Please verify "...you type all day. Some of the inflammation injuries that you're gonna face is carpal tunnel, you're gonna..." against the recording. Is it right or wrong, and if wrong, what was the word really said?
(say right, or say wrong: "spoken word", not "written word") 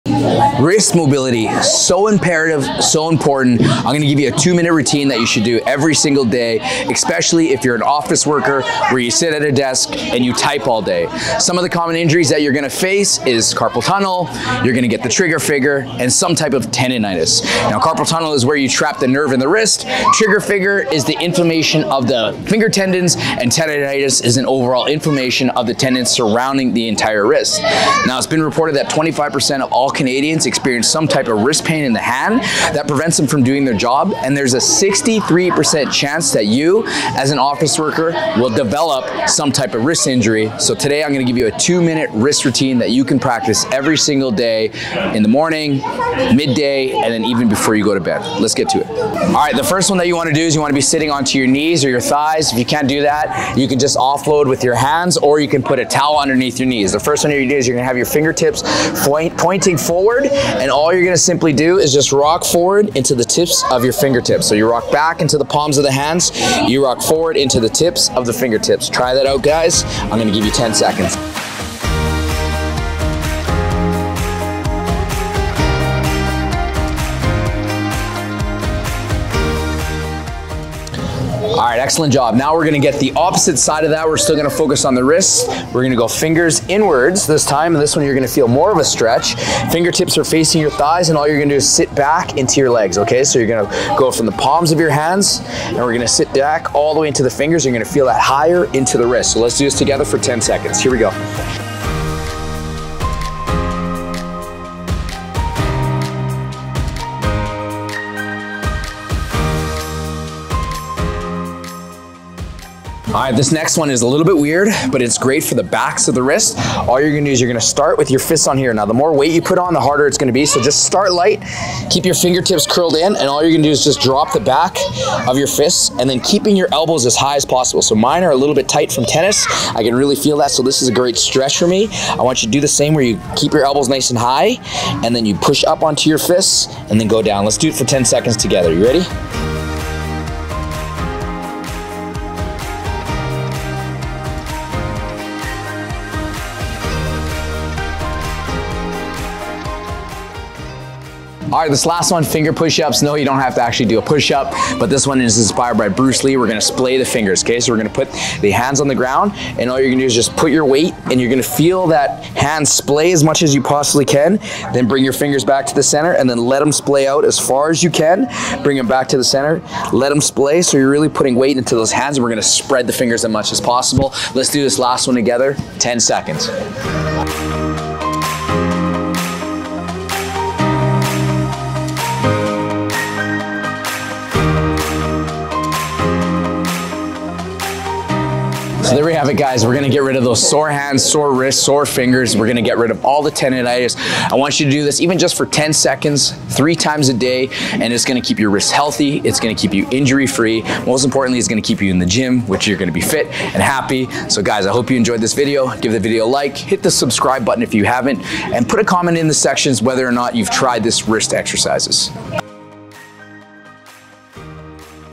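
wrong: "common", not "inflammation".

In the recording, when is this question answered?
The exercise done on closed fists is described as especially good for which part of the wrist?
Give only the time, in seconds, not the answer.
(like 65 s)
115 s.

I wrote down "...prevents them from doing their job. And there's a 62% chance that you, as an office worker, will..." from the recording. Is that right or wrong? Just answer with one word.
wrong.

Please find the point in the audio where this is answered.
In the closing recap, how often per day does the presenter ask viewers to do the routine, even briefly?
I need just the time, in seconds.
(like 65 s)
196 s.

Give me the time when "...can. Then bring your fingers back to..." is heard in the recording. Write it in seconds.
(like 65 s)
164 s.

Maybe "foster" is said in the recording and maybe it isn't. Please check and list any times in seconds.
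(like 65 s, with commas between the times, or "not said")
not said.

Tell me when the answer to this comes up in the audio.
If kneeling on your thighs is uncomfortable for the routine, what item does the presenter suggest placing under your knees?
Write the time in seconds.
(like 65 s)
55 s.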